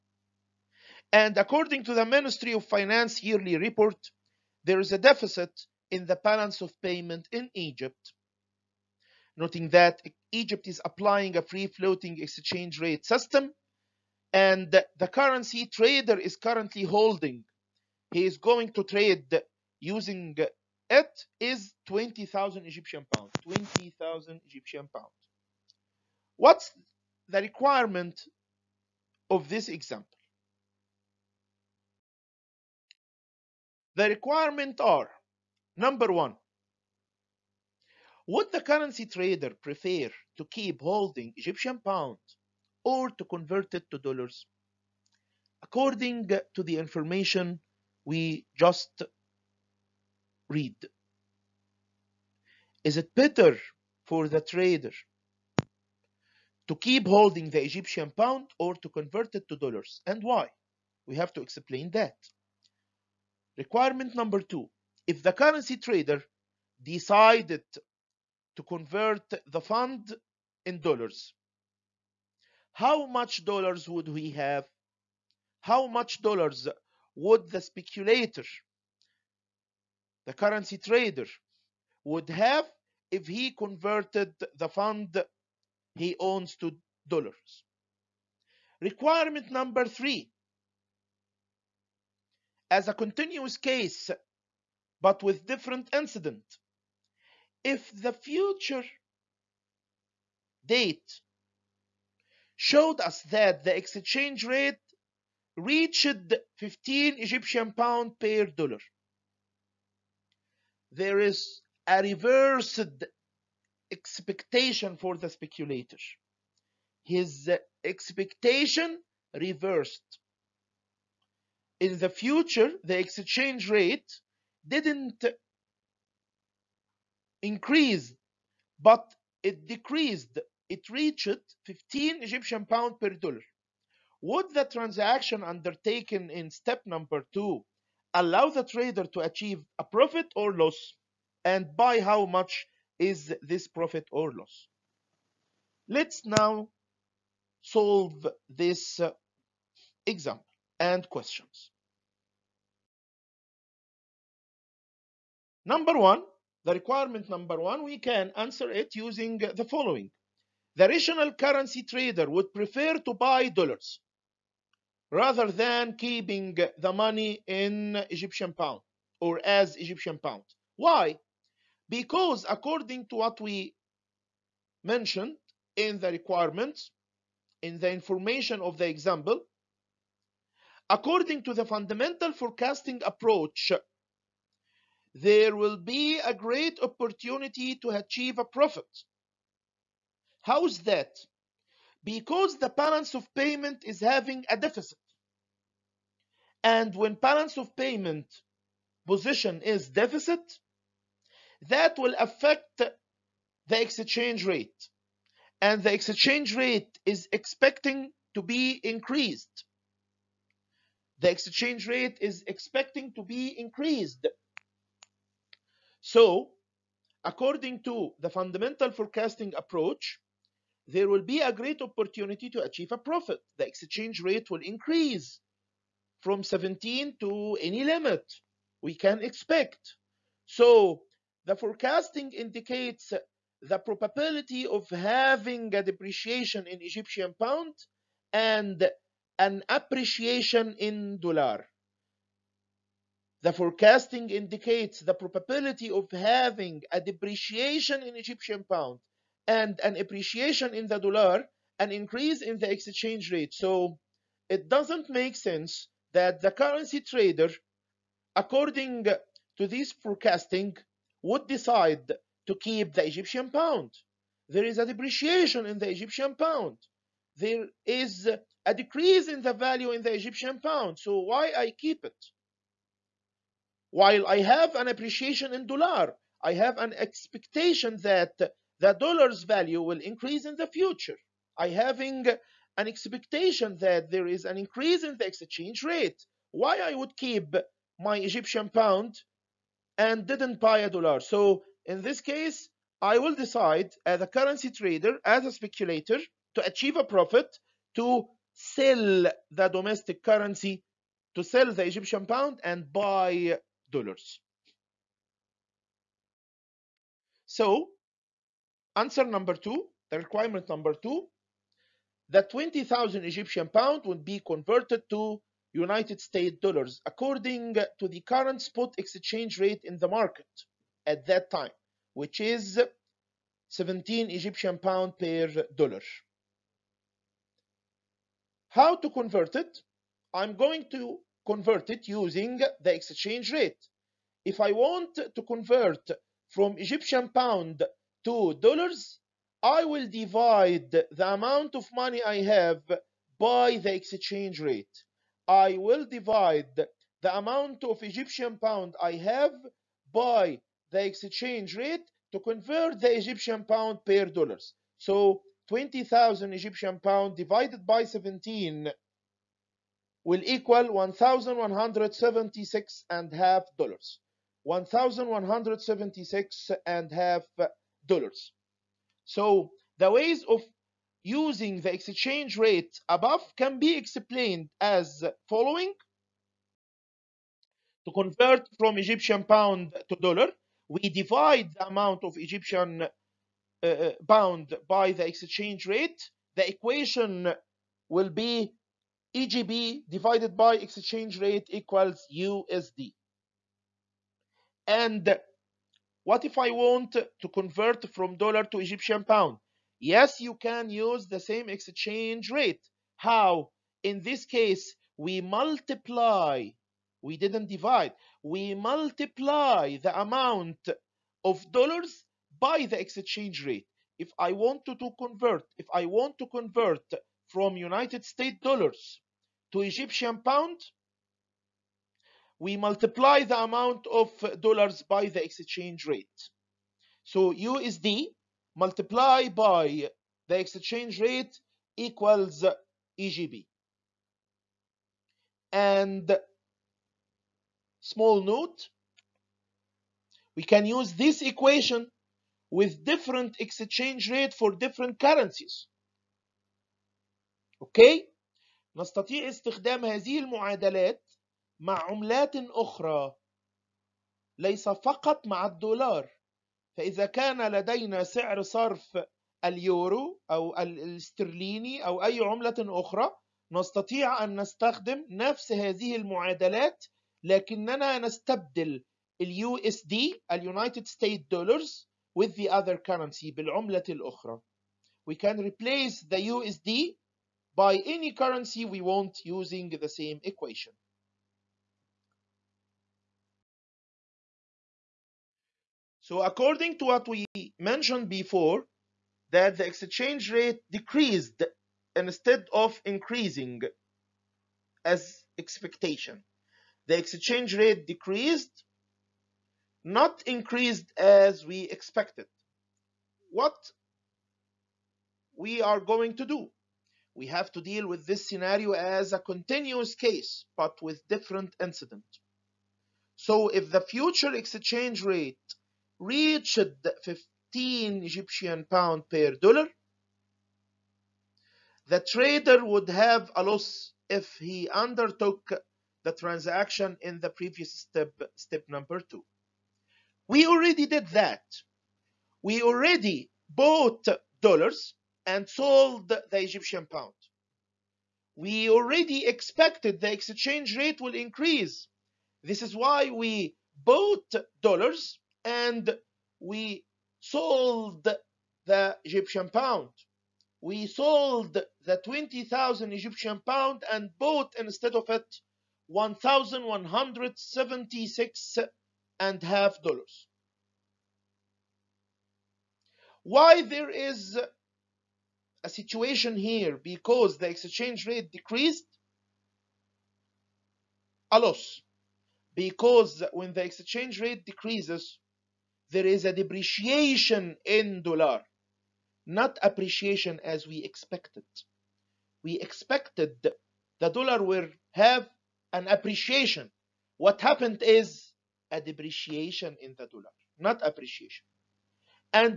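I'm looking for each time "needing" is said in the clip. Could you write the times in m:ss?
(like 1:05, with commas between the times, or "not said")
not said.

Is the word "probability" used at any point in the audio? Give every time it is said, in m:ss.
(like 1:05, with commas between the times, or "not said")
3:53, 4:05.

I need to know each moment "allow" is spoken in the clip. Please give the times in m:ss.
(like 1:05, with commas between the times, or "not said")
2:18.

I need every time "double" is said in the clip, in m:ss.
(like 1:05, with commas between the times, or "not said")
not said.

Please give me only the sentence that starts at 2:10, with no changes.
It reached 15 Egyptian pound per dollar.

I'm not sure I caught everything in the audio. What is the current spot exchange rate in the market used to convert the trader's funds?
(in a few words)
17 Egyptian pounds per dollar.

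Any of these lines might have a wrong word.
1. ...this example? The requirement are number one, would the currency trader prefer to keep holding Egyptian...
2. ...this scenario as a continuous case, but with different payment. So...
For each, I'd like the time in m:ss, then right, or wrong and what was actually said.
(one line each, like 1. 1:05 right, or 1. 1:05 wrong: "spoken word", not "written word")
1. 0:29 right
2. 8:28 wrong: "incident", not "payment".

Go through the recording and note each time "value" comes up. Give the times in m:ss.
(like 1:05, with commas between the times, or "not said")
4:29, 4:39.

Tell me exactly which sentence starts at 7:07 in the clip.
So USD multiplied by the exchange rate equals EGP.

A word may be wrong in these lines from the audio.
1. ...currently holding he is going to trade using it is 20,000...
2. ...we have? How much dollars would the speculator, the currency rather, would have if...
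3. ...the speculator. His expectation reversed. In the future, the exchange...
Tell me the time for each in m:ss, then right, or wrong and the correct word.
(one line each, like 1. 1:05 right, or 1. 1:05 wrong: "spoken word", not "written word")
1. 0:16 right
2. 1:14 wrong: "trader", not "rather"
3. 1:55 right.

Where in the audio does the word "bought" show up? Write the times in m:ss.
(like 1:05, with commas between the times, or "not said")
8:53, 9:04, 9:14.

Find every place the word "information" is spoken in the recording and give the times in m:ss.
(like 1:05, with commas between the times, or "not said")
0:46, 2:57.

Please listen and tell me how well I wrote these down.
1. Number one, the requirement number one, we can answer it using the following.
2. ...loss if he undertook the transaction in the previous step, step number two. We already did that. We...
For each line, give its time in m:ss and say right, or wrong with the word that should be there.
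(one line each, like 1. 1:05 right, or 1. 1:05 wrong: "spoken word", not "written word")
1. 2:35 right
2. 8:43 right.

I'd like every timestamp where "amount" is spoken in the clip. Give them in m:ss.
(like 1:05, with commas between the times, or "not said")
5:41, 5:47, 6:21, 6:50, 7:03.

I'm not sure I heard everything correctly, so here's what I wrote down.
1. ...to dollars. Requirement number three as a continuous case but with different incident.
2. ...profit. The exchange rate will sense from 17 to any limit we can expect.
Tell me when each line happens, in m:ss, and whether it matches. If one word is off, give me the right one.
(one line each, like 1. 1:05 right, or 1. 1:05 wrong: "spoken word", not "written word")
1. 1:26 right
2. 3:42 wrong: "increase", not "sense".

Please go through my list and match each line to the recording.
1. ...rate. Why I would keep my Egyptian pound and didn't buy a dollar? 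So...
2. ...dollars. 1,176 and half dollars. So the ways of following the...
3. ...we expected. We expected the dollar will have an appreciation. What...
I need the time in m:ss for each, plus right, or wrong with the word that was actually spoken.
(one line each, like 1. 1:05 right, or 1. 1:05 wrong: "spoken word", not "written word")
1. 4:45 right
2. 6:03 wrong: "using", not "following"
3. 9:40 right.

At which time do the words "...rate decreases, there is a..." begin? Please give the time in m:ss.
9:34.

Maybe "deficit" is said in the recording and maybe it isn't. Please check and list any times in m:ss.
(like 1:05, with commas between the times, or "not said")
0:04, 3:14, 3:19.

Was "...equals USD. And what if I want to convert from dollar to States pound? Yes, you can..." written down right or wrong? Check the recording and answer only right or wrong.
wrong.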